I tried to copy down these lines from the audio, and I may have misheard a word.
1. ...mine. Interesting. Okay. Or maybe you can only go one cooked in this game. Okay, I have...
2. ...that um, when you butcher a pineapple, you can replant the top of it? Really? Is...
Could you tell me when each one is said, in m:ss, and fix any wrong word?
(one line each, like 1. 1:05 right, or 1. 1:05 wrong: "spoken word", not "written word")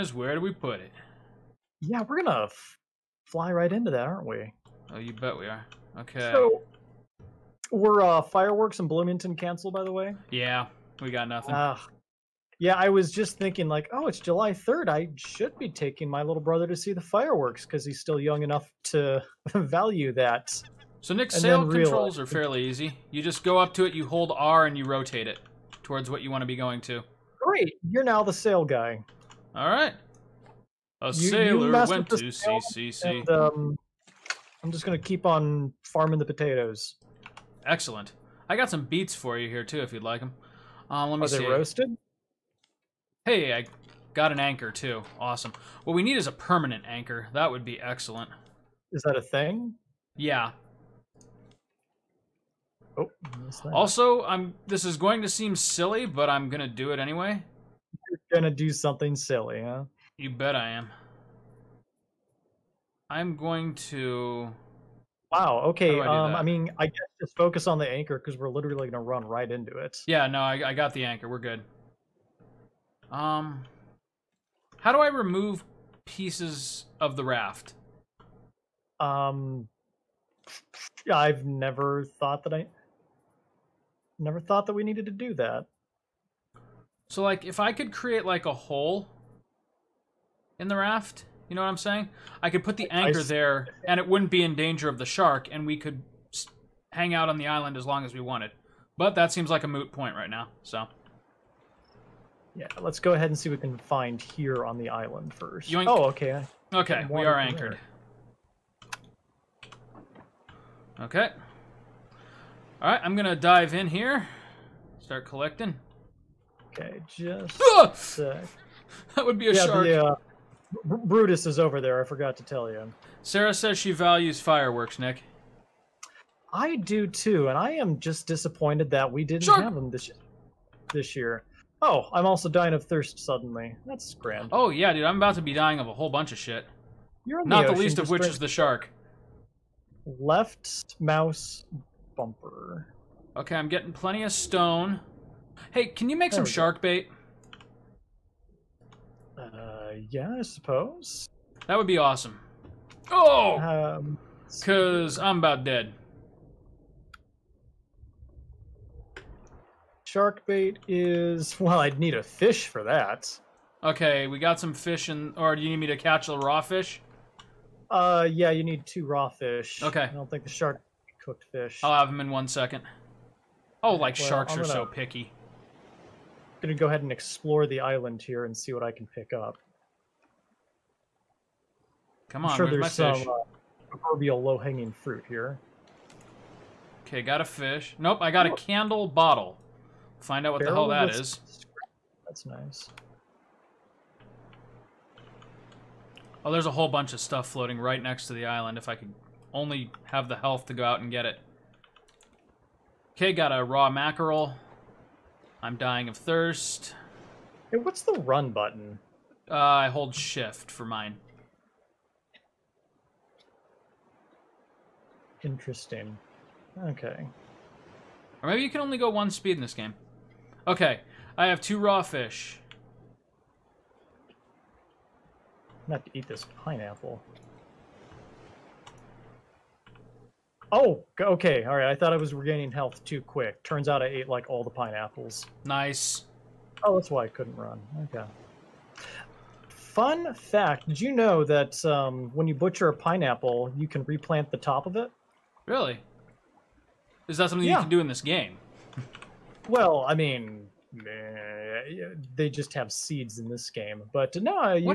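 1. 3:30 wrong: "speed", not "cooked"
2. 4:01 right.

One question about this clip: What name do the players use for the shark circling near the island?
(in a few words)
Brutus.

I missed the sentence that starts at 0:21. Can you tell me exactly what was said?
So, Nick's and sail controls are fairly easy.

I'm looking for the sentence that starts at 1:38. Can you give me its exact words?
But that seems like a moot point right now.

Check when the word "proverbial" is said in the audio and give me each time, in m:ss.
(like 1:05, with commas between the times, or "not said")
3:03.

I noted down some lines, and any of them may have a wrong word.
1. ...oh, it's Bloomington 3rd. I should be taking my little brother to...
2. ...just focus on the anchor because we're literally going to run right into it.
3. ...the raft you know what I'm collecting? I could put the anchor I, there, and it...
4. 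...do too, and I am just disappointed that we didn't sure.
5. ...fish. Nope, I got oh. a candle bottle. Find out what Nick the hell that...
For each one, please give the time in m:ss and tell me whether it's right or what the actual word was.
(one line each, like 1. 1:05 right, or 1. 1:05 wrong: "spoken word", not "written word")
1. 0:13 wrong: "July", not "Bloomington"
2. 1:07 right
3. 1:30 wrong: "saying", not "collecting"
4. 2:06 right
5. 3:07 wrong: "Barrel", not "Nick".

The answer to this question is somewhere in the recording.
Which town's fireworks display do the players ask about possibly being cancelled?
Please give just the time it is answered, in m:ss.
0:08.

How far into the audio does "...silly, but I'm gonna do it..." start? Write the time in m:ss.
0:55.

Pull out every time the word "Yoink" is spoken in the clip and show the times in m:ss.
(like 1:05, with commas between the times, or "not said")
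1:45.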